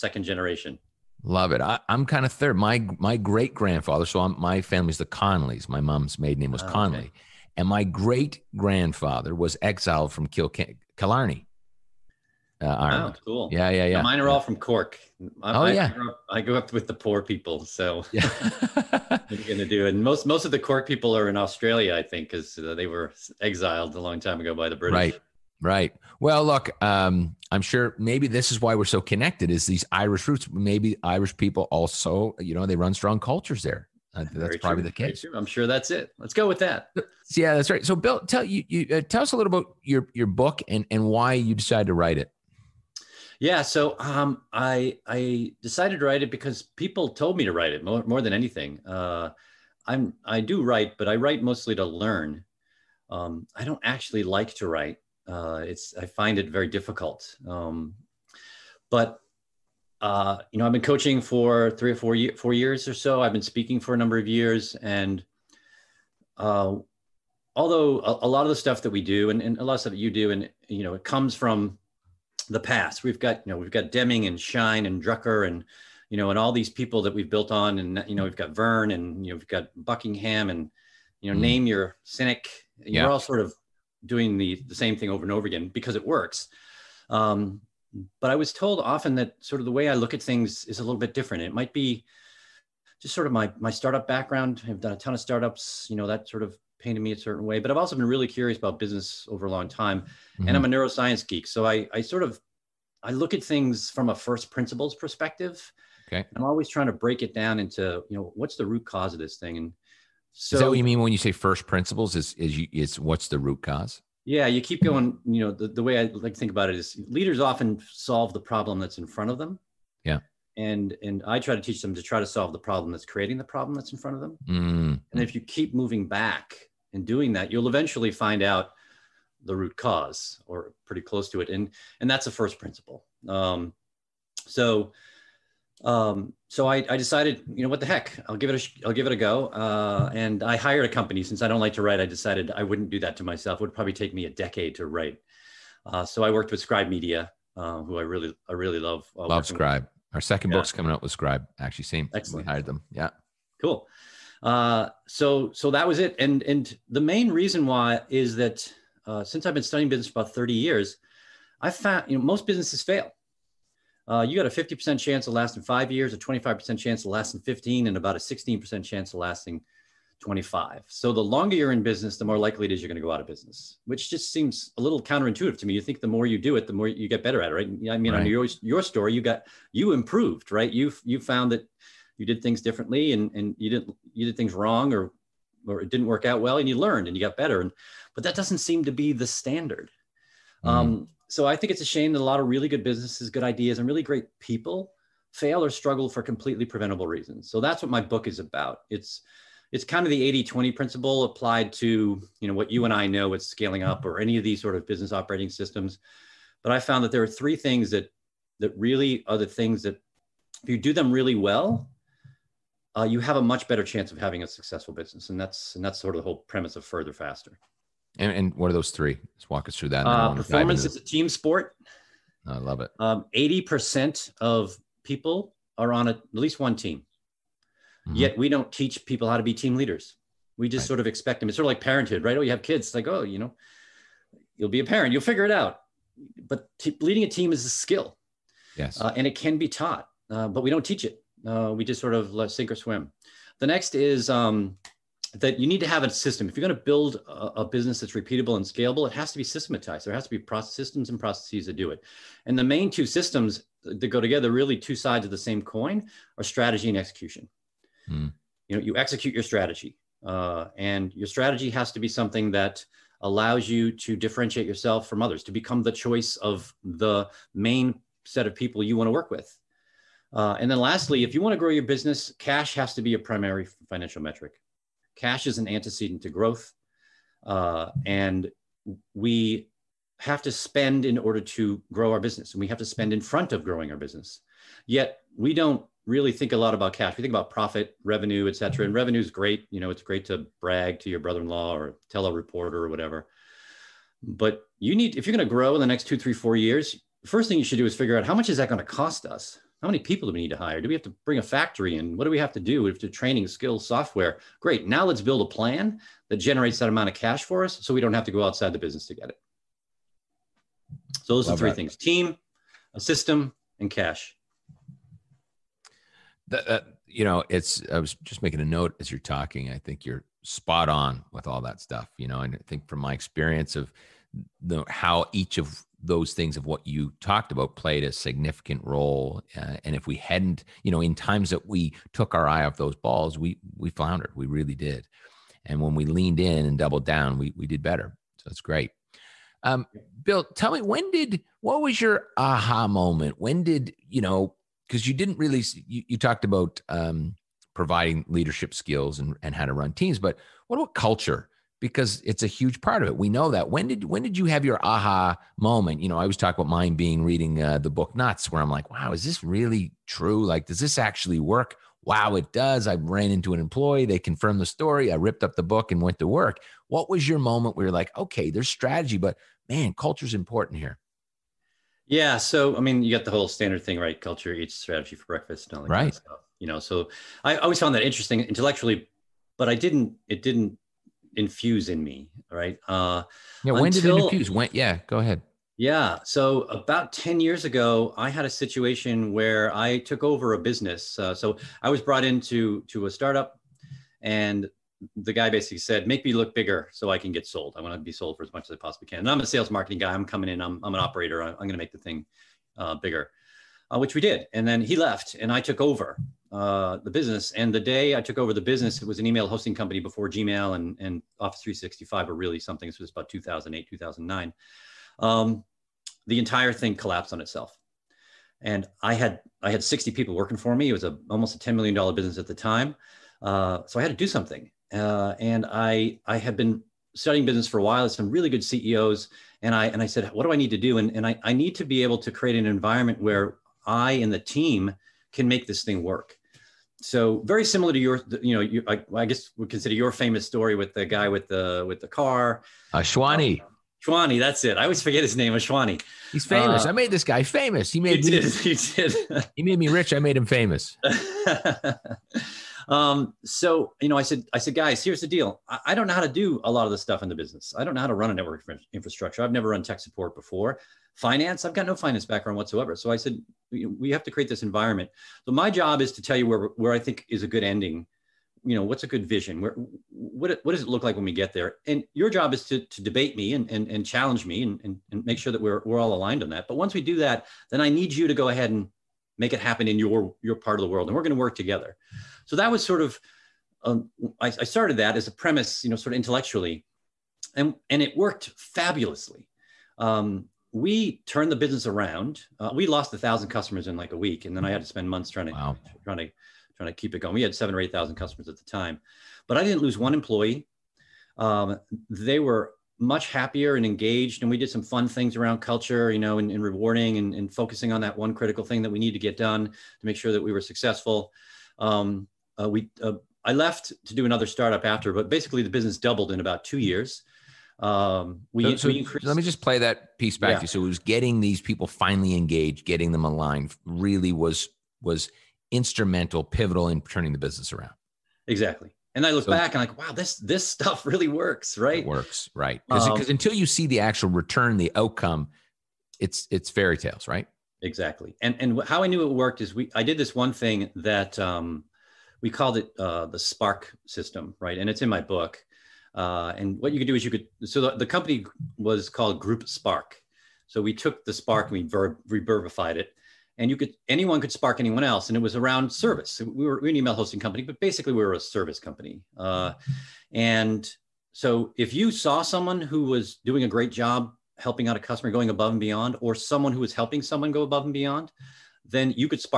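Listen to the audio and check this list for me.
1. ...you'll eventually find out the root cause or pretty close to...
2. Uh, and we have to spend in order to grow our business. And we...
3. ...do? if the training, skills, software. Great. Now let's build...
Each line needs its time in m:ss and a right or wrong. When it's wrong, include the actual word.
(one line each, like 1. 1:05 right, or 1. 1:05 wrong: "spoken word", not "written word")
1. 2:07 right
2. 4:37 right
3. 5:02 right.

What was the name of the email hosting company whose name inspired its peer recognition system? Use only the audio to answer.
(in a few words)
Group Spark.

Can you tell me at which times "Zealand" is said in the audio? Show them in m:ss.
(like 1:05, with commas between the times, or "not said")
not said.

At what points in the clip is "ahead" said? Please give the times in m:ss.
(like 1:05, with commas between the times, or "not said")
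6:25, 7:58.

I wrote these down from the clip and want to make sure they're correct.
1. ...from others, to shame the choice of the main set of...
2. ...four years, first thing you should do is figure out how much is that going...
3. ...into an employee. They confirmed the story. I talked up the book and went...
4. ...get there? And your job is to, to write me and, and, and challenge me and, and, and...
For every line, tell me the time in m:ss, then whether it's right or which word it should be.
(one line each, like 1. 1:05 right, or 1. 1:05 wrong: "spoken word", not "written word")
1. 4:25 wrong: "become", not "shame"
2. 4:56 right
3. 6:03 wrong: "ripped", not "talked"
4. 7:51 wrong: "debate", not "write".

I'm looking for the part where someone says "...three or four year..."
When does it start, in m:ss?
1:01.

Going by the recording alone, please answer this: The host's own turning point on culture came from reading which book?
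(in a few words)
Nuts.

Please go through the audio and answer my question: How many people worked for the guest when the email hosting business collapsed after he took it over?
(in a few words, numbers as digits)
60.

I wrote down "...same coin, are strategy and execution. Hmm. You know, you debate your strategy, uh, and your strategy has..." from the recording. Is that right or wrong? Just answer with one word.
wrong.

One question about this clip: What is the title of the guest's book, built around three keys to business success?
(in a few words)
Further Faster.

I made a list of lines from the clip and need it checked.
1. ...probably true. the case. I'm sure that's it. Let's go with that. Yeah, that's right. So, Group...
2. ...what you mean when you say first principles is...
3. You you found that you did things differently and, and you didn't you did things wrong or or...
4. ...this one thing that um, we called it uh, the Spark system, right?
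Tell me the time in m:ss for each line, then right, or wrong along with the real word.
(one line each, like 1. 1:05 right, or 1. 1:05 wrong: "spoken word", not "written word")
1. 0:34 wrong: "Bill", not "Group"
2. 1:50 right
3. 3:00 right
4. 9:00 right.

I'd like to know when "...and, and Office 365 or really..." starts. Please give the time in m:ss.
6:50.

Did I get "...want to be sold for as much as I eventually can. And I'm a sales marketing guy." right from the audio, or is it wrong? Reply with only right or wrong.
wrong.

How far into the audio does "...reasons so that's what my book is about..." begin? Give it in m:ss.
3:17.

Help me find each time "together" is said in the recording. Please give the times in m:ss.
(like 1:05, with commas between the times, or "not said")
4:14, 8:01.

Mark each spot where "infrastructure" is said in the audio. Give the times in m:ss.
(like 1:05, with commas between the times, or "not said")
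7:38.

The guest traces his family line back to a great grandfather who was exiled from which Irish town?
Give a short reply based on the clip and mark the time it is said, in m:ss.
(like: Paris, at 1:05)
Killarney, at 0:10.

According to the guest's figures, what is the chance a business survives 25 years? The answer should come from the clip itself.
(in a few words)
16%.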